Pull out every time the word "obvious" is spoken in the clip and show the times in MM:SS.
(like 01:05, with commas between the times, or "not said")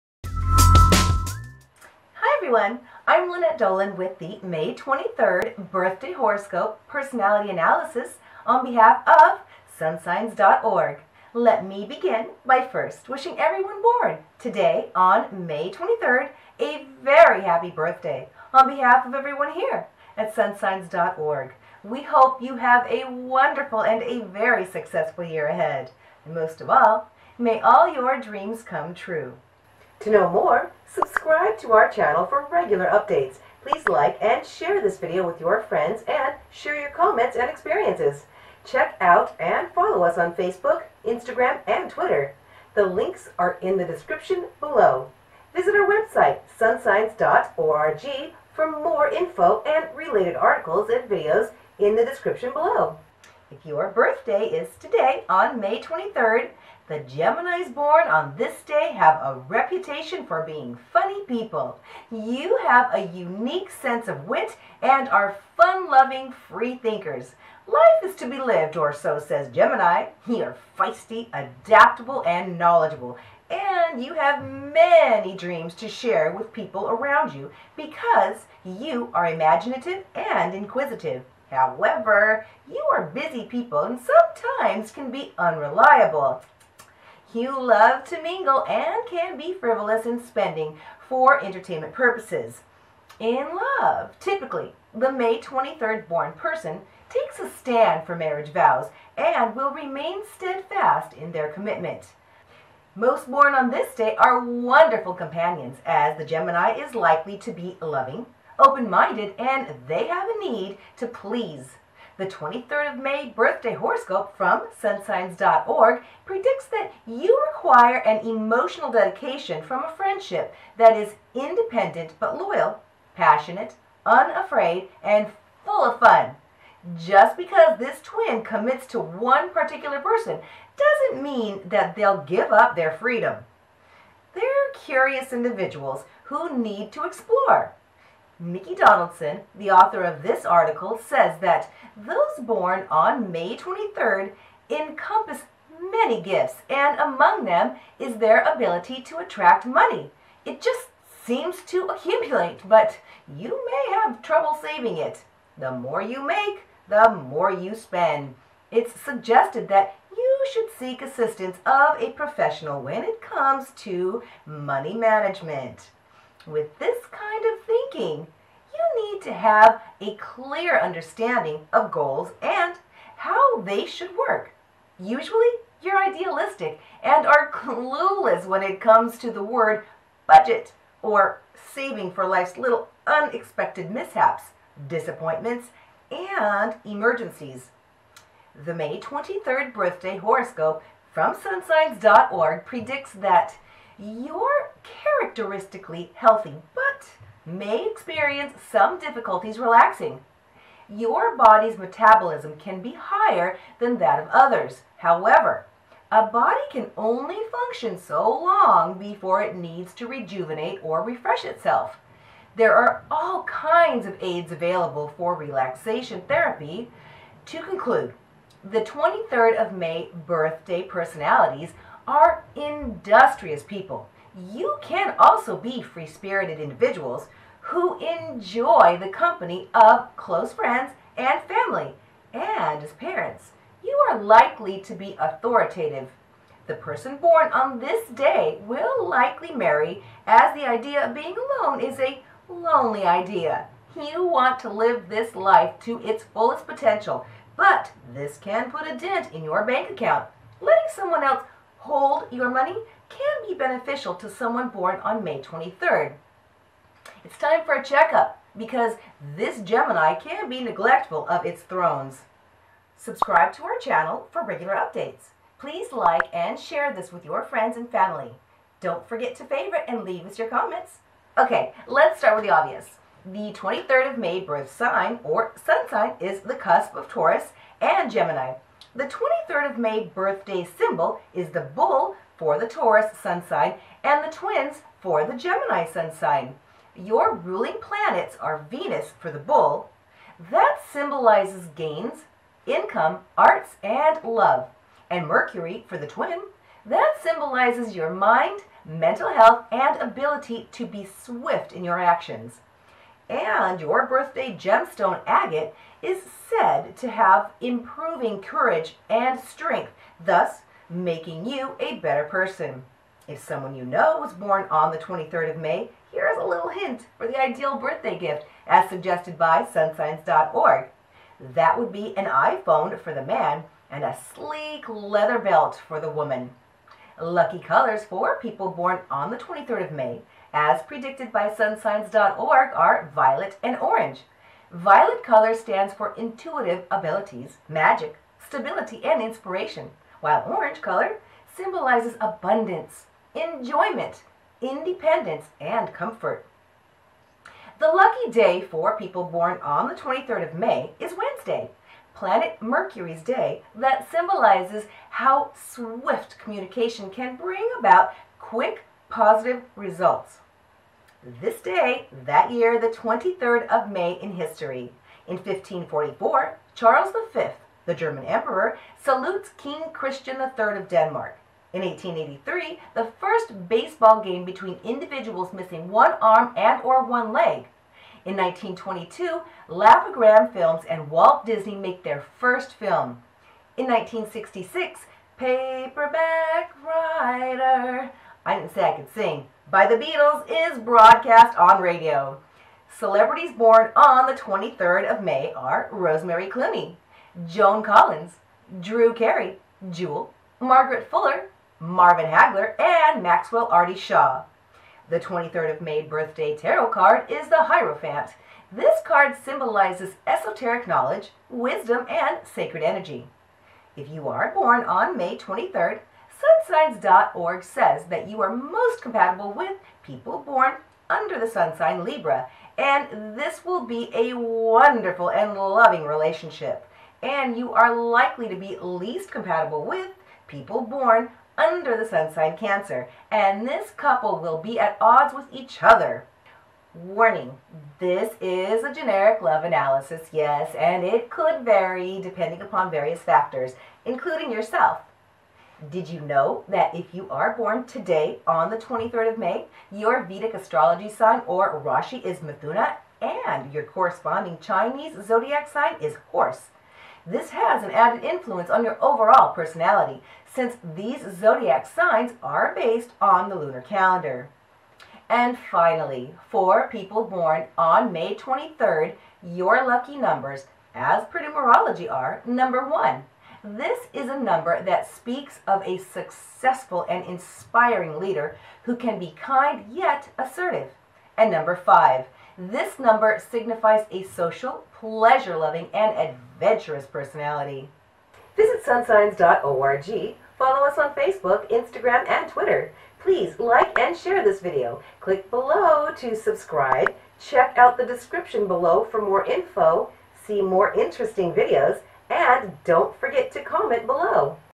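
04:32.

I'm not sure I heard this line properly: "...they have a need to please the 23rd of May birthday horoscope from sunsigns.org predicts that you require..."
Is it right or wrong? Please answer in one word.
right.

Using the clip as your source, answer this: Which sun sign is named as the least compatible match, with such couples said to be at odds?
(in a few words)
Cancer.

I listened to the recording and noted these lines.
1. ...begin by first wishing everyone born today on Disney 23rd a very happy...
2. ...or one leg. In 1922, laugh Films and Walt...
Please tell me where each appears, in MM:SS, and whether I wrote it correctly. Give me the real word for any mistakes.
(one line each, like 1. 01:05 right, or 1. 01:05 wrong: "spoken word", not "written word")
1. 00:11 wrong: "May", not "Disney"
2. 06:16 right.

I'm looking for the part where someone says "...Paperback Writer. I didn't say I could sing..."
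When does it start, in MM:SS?
06:25.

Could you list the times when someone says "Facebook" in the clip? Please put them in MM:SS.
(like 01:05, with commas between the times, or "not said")
00:40, 08:11.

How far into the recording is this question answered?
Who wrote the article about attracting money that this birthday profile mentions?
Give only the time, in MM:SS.
02:18.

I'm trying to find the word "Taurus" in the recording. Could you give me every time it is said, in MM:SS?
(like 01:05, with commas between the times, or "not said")
04:37, 04:42.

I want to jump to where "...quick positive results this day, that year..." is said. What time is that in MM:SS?
05:58.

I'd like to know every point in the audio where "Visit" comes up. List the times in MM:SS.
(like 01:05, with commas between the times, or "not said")
00:45, 08:08.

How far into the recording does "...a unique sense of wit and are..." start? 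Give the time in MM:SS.
01:02.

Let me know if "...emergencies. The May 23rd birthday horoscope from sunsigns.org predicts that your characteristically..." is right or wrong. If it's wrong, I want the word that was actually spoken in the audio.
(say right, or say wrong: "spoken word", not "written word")
right.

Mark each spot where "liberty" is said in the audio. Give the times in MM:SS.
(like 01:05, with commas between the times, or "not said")
not said.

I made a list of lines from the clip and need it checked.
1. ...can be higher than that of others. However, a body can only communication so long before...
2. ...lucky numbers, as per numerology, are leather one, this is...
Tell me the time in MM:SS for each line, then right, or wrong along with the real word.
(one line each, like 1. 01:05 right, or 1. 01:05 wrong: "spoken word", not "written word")
1. 03:22 wrong: "function", not "communication"
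2. 07:49 wrong: "number", not "leather".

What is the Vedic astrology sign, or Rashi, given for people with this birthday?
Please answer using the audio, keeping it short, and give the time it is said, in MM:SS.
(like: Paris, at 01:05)
Mithuna, at 07:32.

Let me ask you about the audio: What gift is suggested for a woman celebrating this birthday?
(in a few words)
A sleek leather belt.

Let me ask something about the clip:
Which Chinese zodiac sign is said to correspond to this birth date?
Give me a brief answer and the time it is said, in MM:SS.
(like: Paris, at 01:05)
Horse, at 07:36.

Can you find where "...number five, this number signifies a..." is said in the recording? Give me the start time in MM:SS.
08:01.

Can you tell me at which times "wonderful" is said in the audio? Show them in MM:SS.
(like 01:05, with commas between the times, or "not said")
00:23, 01:44, 07:04.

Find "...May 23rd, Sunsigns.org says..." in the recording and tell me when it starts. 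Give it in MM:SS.
06:55.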